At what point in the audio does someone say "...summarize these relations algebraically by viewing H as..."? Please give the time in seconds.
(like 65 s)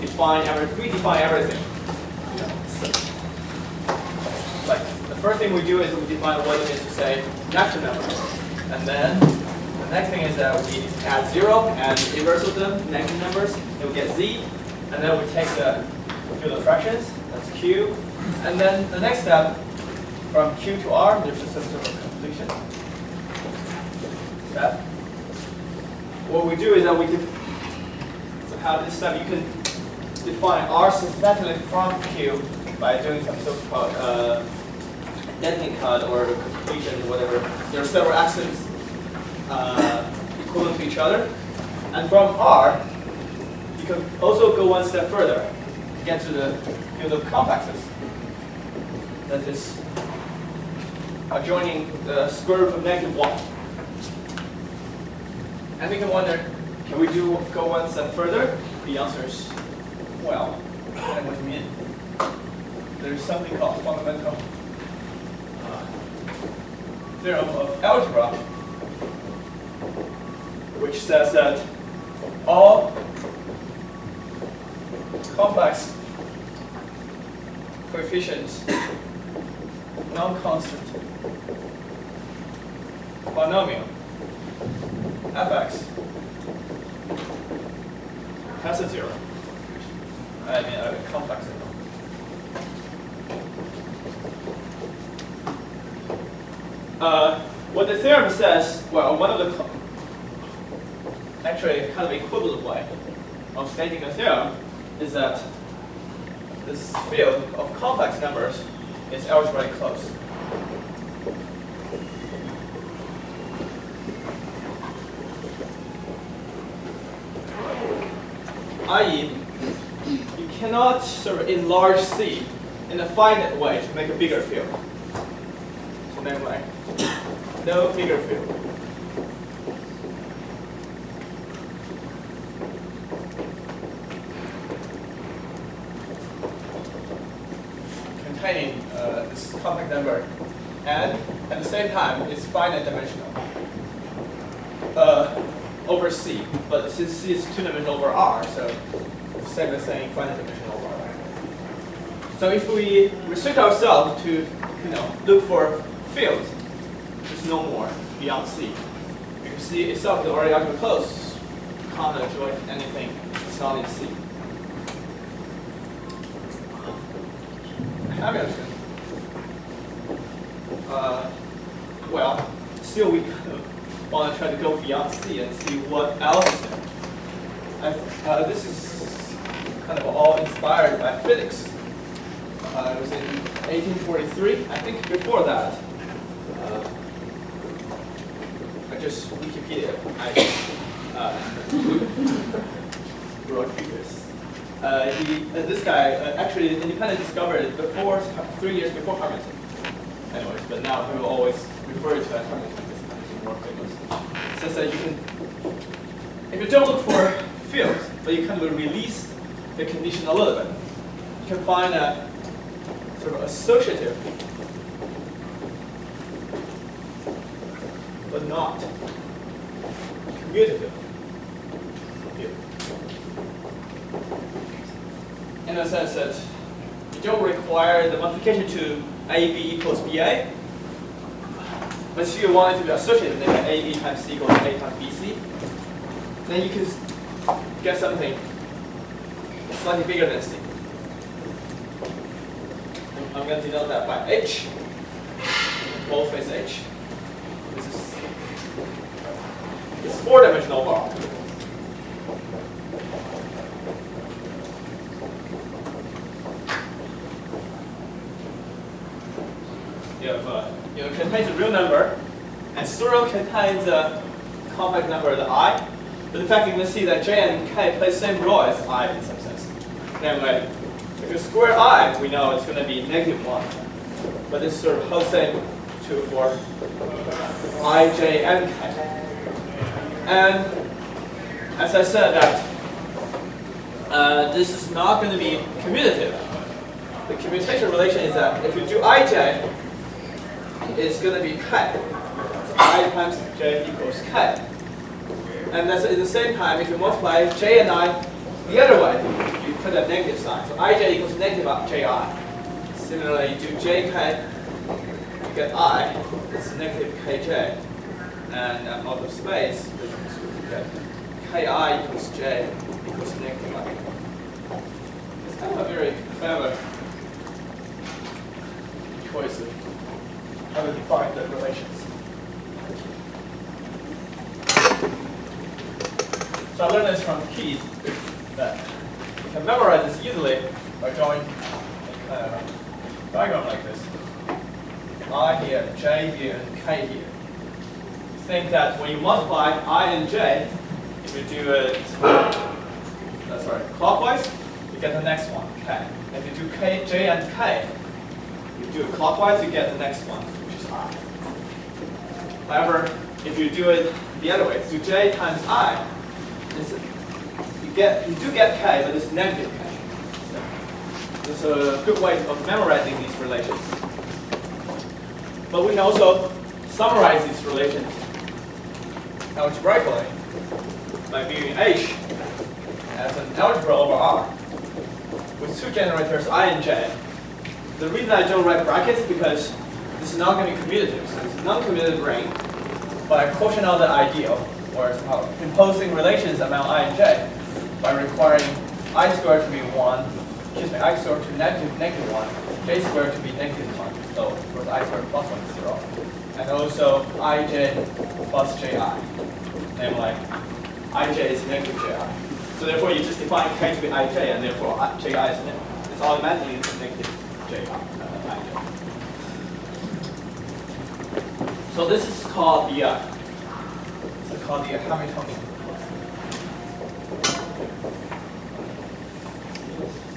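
366 s.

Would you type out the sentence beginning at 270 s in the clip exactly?
Namely, if you square i, we know it's going to be negative 1.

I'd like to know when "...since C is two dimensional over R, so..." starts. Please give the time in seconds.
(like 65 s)
146 s.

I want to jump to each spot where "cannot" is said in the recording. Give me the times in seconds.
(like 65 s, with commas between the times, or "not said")
120 s.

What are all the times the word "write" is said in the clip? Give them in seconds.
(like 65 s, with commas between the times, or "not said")
378 s.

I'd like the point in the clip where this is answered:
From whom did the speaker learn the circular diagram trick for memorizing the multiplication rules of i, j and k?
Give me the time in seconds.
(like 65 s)
327 s.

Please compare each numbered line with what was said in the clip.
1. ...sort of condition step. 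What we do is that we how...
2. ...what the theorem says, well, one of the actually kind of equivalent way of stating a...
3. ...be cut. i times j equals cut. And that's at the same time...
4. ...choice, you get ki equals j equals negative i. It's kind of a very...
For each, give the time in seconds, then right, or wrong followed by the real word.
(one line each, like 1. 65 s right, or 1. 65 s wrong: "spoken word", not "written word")
1. 21 s wrong: "completion", not "condition"
2. 97 s right
3. 291 s right
4. 309 s wrong: "space", not "choice".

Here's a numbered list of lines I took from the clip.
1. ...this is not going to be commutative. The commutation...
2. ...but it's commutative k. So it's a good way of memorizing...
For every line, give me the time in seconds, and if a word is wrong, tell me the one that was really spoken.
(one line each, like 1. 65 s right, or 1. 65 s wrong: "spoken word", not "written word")
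1. 284 s right
2. 359 s wrong: "negative", not "commutative".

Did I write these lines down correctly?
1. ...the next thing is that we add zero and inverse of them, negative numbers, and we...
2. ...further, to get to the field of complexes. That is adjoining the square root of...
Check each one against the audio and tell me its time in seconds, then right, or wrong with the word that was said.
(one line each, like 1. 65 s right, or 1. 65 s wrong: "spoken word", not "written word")
1. 9 s right
2. 45 s right.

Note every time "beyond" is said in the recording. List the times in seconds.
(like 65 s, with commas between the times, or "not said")
158 s, 174 s.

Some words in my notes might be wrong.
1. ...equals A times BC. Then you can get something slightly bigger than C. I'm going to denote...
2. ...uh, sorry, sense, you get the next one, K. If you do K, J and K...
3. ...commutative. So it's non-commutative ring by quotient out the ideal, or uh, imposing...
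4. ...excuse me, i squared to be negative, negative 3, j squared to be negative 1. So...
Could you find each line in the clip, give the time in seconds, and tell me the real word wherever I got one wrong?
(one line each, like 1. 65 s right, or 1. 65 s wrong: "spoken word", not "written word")
1. 234 s right
2. 342 s wrong: "clockwise", not "sense"
3. 380 s right
4. 390 s wrong: "1", not "3".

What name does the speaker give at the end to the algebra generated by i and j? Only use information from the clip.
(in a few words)
Hamiltonian.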